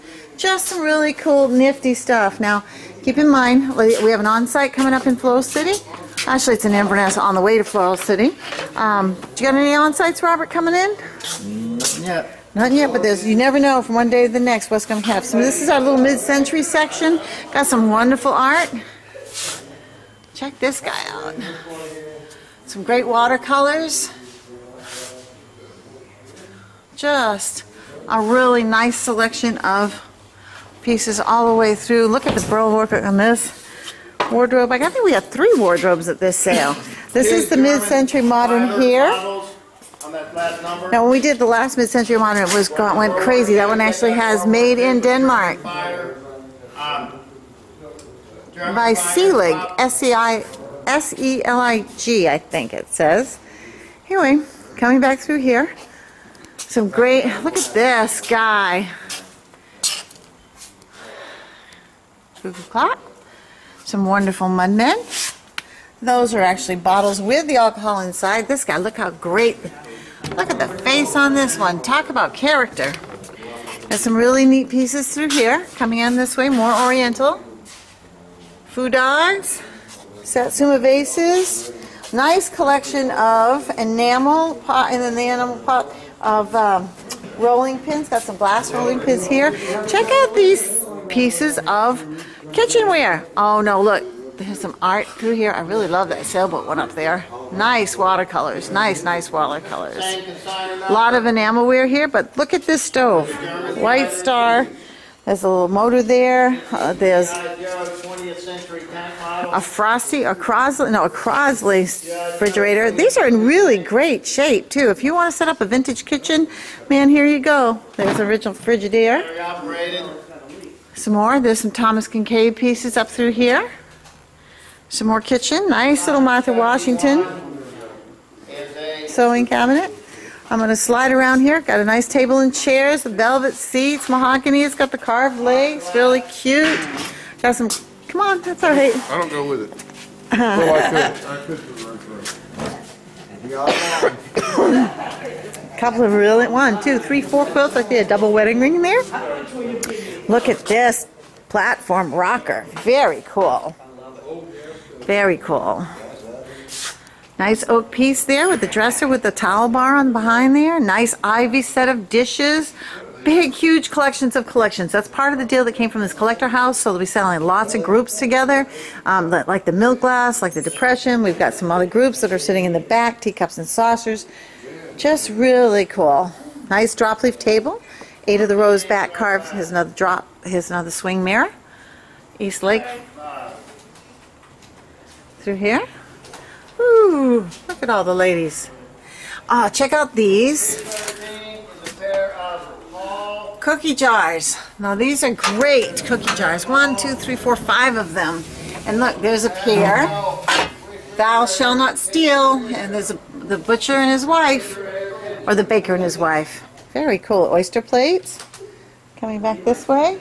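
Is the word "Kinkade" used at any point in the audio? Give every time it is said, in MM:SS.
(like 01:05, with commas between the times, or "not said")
02:02.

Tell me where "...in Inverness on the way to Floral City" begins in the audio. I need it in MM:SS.
00:06.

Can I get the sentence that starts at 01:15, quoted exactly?
Coming in this way, more oriental.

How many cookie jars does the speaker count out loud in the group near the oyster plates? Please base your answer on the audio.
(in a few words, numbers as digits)
5.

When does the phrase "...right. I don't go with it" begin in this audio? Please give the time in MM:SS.
02:18.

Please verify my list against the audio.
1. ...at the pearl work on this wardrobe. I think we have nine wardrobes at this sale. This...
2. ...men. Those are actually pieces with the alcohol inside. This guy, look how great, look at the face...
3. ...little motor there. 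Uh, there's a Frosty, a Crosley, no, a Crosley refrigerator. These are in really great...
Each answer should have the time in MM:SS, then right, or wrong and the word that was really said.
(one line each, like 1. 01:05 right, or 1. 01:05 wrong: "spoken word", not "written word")
1. 00:32 wrong: "three", not "nine"
2. 01:04 wrong: "bottles", not "pieces"
3. 01:45 right.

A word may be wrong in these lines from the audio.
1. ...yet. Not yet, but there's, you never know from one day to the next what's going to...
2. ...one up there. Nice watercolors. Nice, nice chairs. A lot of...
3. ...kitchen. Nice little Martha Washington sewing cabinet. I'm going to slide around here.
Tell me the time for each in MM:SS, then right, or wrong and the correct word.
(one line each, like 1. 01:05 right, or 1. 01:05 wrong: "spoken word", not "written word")
1. 00:12 right
2. 01:36 wrong: "watercolors", not "chairs"
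3. 02:05 right.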